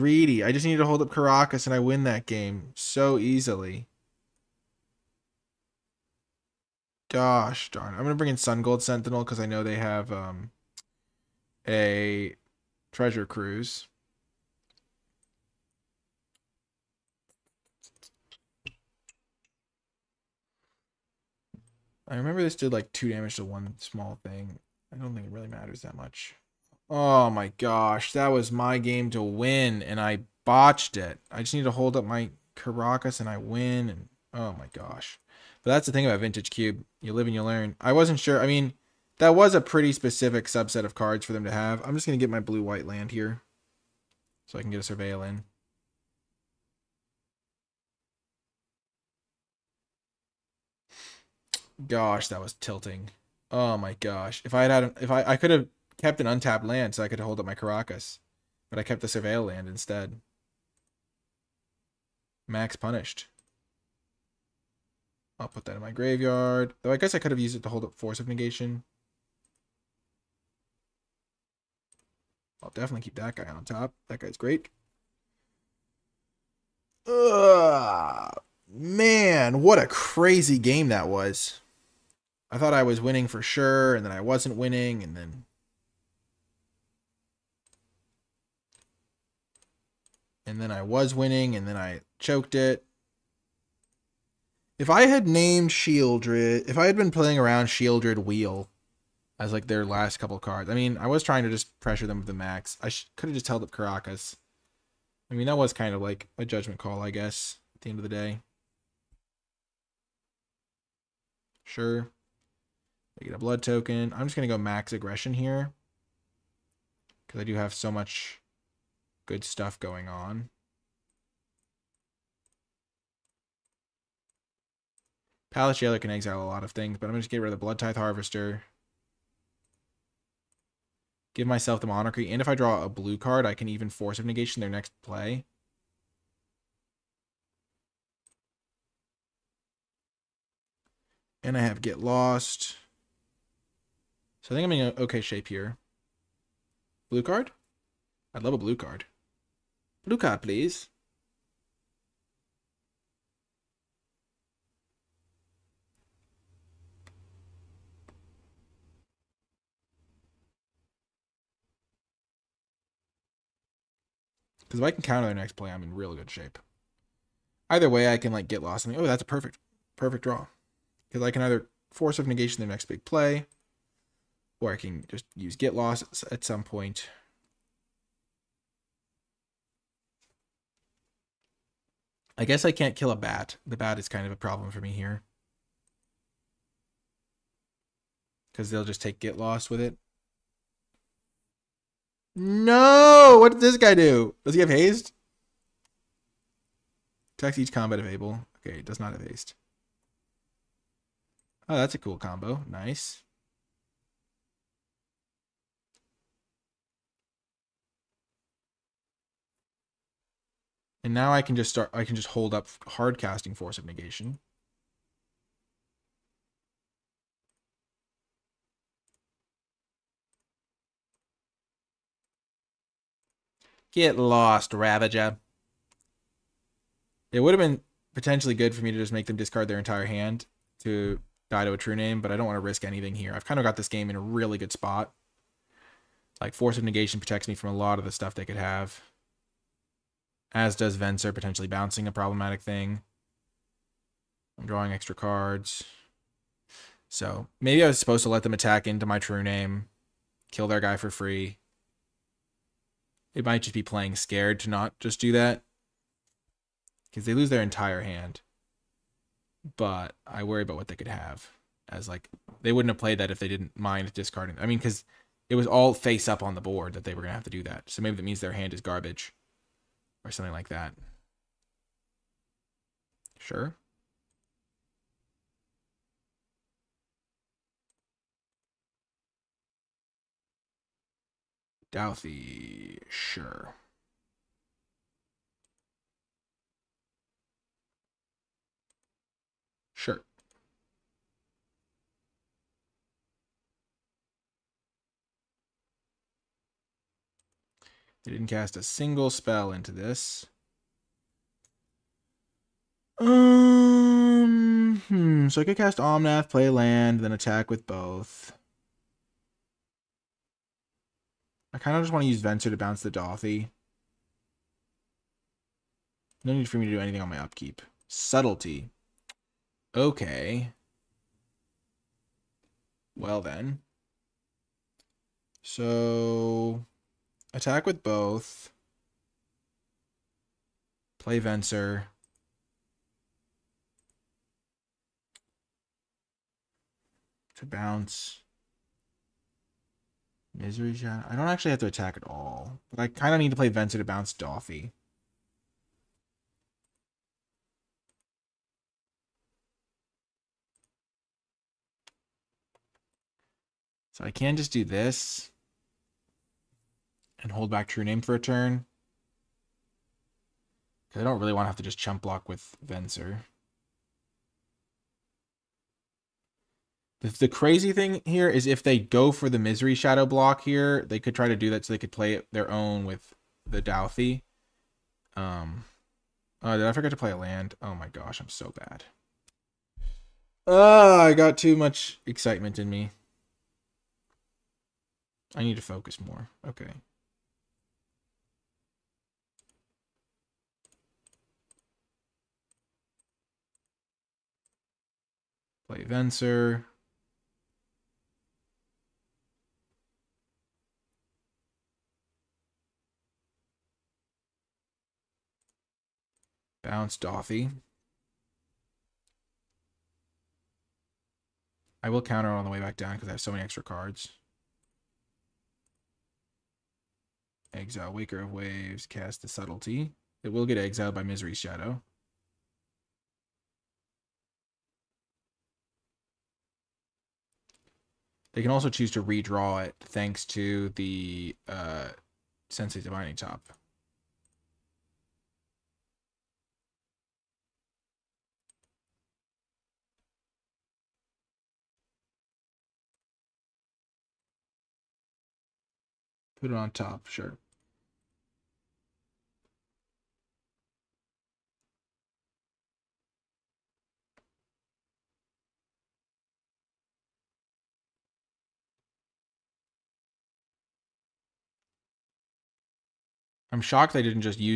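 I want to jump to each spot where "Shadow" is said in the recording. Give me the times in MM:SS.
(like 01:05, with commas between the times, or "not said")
05:40, 06:09, 07:01.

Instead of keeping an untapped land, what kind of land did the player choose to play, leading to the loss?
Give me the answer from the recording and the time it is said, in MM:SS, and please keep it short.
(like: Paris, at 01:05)
Surveil land, at 00:59.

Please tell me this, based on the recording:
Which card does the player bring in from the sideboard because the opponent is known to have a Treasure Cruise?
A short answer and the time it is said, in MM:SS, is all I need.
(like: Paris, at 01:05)
Sungold Sentinel, at 00:08.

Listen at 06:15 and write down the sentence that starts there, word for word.
Um, oh, did I forget to play a land?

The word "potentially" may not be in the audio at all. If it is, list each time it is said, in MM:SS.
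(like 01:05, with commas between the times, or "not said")
03:48, 04:01.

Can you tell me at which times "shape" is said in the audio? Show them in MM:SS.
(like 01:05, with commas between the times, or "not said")
02:25, 02:46.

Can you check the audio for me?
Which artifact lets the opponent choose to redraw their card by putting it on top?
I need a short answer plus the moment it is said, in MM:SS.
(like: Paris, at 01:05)
Sensei's Divining Top, at 07:12.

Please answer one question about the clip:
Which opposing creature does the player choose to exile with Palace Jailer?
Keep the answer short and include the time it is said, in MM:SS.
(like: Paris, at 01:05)
Blood Tithe Harvester, at 02:07.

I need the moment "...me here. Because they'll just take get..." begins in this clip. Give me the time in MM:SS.
03:04.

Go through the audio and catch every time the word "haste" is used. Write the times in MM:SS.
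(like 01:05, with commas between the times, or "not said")
03:14, 03:19.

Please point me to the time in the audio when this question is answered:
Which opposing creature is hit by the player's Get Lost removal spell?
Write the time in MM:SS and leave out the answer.
03:44.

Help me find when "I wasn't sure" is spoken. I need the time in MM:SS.
00:37.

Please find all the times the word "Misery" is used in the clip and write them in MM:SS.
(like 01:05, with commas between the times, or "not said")
05:40, 06:09, 07:01.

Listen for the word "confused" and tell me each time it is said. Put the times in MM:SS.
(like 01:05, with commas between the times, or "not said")
not said.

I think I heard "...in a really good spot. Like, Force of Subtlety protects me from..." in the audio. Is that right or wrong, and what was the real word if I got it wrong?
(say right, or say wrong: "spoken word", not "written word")
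wrong: "Negation", not "Subtlety".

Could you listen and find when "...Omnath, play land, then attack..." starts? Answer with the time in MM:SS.
05:05.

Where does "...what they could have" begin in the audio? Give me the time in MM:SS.
04:20.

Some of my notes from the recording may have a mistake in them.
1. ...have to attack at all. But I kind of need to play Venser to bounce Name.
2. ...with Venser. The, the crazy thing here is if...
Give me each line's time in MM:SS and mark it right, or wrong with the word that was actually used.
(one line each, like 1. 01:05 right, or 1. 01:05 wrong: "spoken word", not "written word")
1. 05:41 wrong: "Dauthi", not "Name"
2. 06:02 right.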